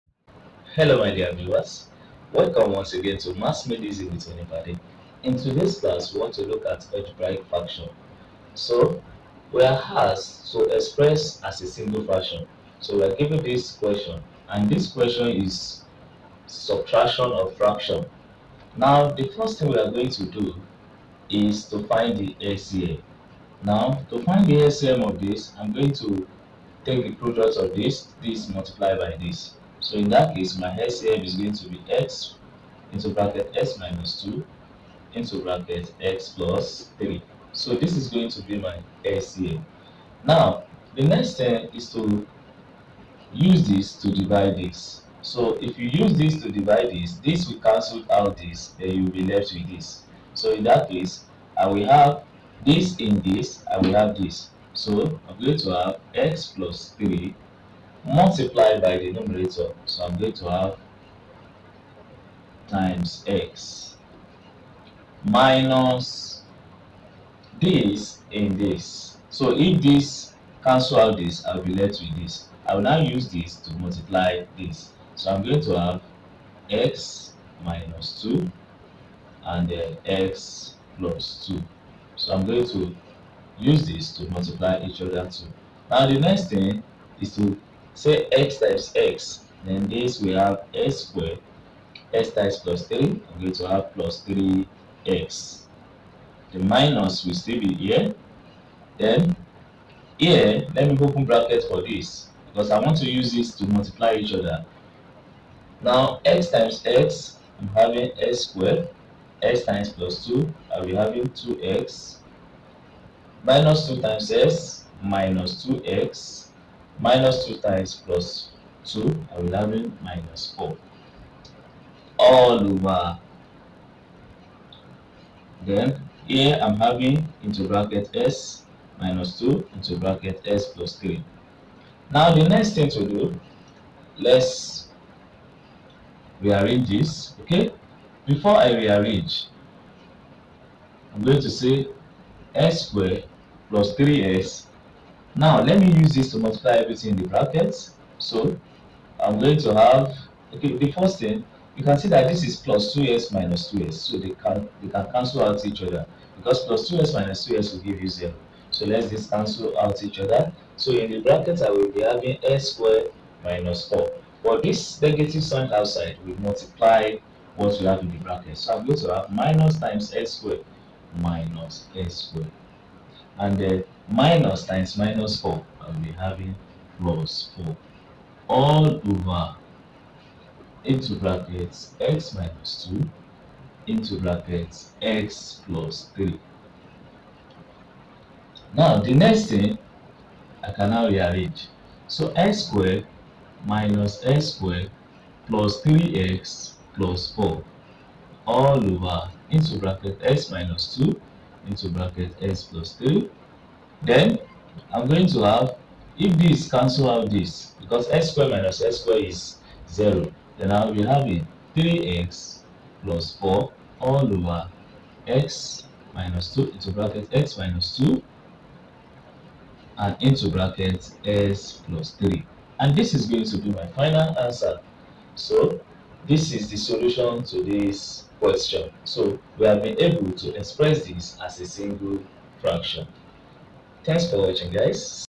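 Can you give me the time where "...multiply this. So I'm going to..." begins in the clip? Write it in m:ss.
1:13.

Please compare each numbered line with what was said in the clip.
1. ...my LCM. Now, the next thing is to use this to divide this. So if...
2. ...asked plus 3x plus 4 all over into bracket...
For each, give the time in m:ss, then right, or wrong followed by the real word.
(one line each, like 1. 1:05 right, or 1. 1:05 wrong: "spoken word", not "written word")
1. 0:38 right
2. 3:14 wrong: "squared", not "asked".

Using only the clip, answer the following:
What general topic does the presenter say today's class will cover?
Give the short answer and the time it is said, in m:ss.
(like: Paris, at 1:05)
algebraic fraction, at 0:06.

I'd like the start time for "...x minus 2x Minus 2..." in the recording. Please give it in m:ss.
1:54.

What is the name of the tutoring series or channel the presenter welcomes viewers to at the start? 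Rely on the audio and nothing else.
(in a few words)
Maths Made Easy.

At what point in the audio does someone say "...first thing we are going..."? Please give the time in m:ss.
0:19.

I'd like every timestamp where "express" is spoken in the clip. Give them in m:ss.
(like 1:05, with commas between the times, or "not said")
0:10, 3:50.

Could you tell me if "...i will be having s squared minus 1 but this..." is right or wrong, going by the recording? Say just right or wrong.
wrong.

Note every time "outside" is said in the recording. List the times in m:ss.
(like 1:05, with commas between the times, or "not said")
2:45.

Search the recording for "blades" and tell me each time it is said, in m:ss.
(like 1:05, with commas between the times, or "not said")
not said.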